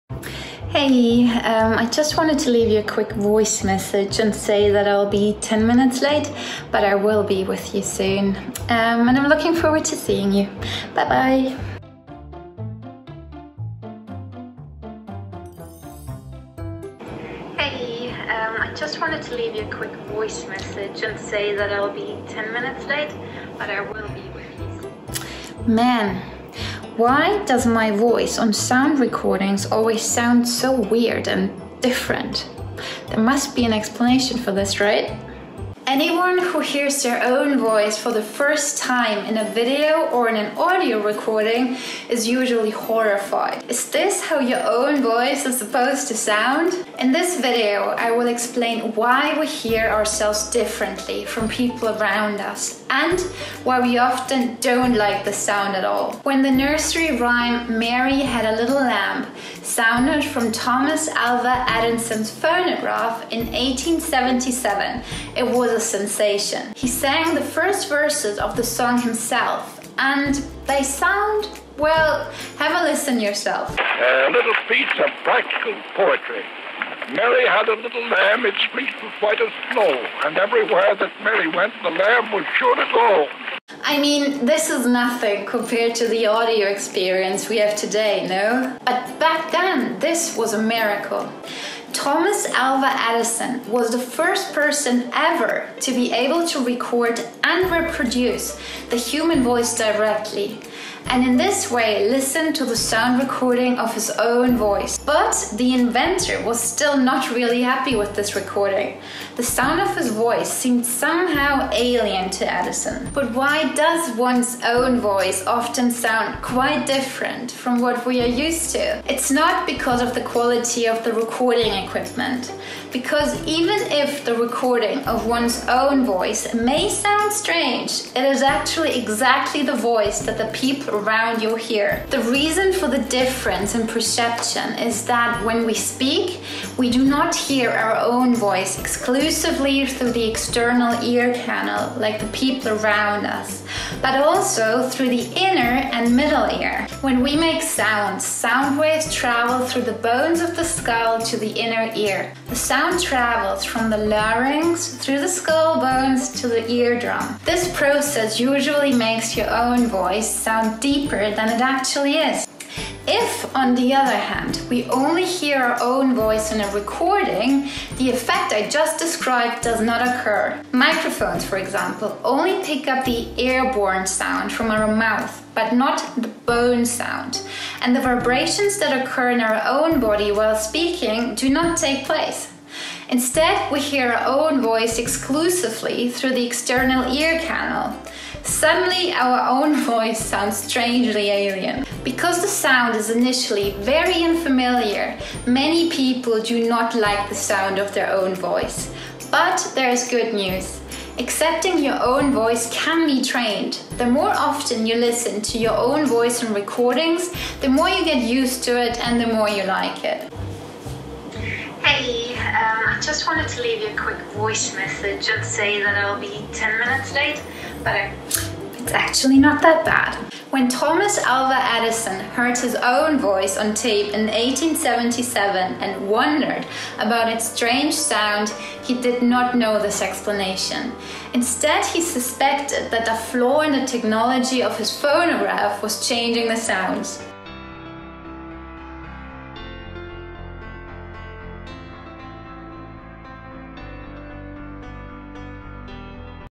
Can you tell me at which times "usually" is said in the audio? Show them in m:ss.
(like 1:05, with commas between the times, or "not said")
0:42, 2:38.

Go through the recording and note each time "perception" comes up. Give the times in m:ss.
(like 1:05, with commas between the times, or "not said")
2:13.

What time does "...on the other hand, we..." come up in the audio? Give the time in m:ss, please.
2:43.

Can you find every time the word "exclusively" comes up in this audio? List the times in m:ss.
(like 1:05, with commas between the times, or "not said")
2:18, 3:04.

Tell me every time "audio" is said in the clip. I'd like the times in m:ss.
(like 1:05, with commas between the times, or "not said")
0:40, 1:26.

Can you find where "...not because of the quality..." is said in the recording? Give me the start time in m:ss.
1:59.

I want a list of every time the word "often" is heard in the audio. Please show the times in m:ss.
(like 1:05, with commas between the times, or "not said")
0:53, 1:55, 3:24.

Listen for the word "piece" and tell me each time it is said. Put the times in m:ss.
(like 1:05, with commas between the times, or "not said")
1:14.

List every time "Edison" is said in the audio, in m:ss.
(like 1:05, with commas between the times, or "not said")
1:01, 1:32, 1:52, 3:41.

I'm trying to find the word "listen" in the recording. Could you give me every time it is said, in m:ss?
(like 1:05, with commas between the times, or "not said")
1:12, 1:42, 3:24.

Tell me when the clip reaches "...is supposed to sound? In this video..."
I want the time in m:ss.
0:45.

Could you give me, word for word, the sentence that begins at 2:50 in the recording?
Microphones, for example, only pick up the airborne sound from our mouth, but not the bone sound.